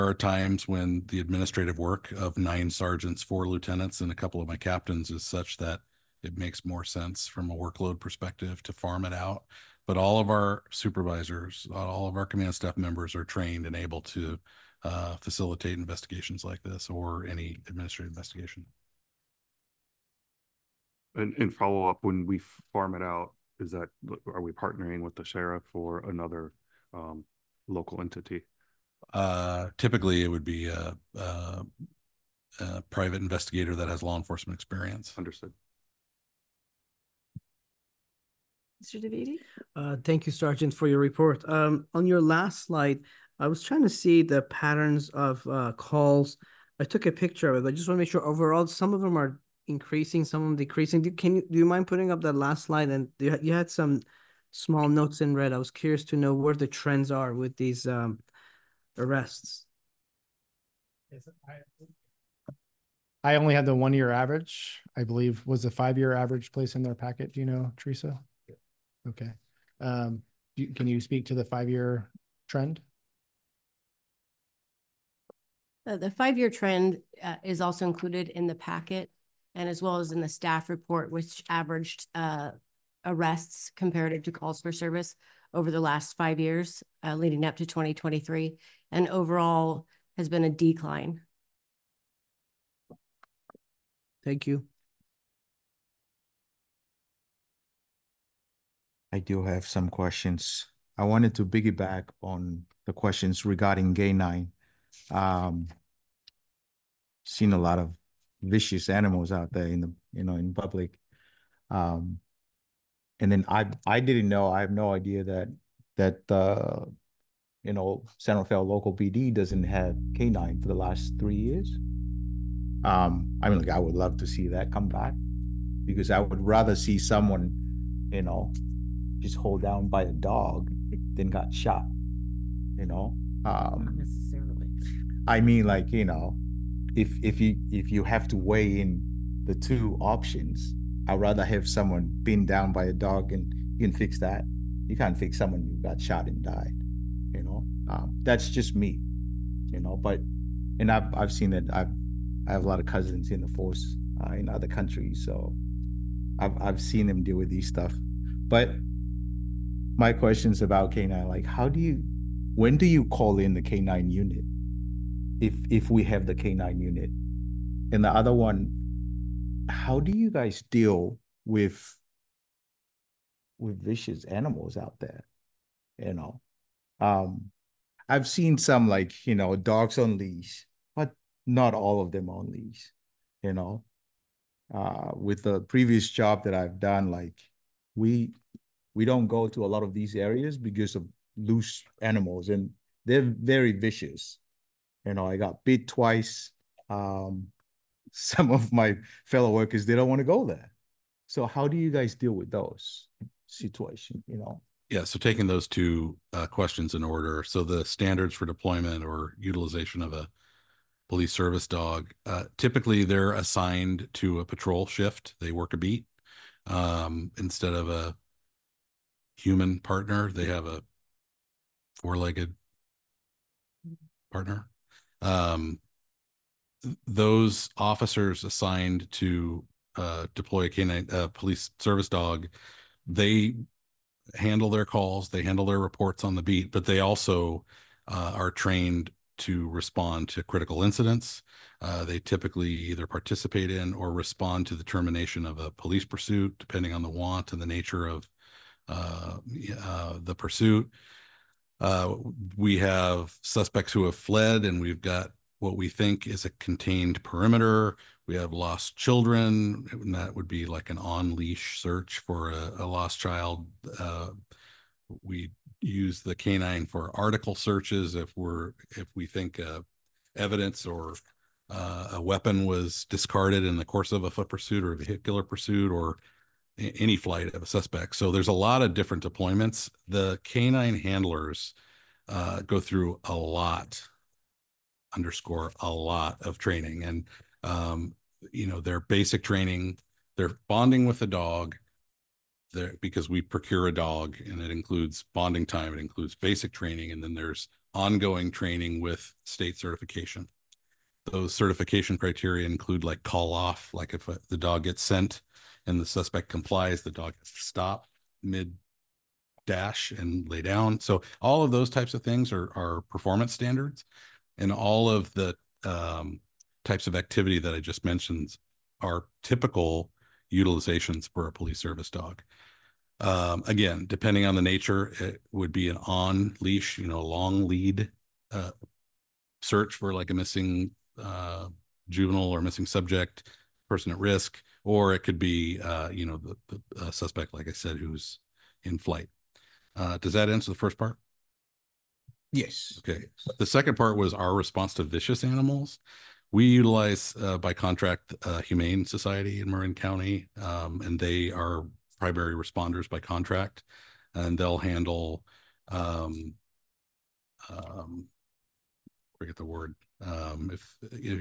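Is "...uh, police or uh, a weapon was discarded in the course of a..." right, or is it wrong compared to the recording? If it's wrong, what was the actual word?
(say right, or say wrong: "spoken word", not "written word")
wrong: "evidence", not "police".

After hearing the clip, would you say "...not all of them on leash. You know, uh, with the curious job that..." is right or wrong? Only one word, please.
wrong.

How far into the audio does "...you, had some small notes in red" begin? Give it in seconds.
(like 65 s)
53 s.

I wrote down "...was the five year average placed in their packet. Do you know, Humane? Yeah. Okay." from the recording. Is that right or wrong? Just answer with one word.
wrong.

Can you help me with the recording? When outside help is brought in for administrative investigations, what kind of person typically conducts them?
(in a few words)
Private investigator.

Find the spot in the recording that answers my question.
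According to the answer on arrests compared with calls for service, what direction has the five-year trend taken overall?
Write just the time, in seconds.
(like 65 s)
90 s.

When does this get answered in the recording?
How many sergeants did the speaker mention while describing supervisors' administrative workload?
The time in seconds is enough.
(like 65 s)
2 s.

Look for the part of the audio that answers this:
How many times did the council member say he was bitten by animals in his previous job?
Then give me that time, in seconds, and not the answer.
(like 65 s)
195 s.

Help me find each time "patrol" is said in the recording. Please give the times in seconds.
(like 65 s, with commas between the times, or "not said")
214 s.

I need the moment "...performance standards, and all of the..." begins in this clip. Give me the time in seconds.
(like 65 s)
313 s.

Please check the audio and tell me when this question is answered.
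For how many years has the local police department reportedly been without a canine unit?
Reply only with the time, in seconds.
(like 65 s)
121 s.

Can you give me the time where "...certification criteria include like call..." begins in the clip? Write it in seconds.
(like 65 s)
301 s.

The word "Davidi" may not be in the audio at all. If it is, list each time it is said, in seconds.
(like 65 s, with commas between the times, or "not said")
39 s.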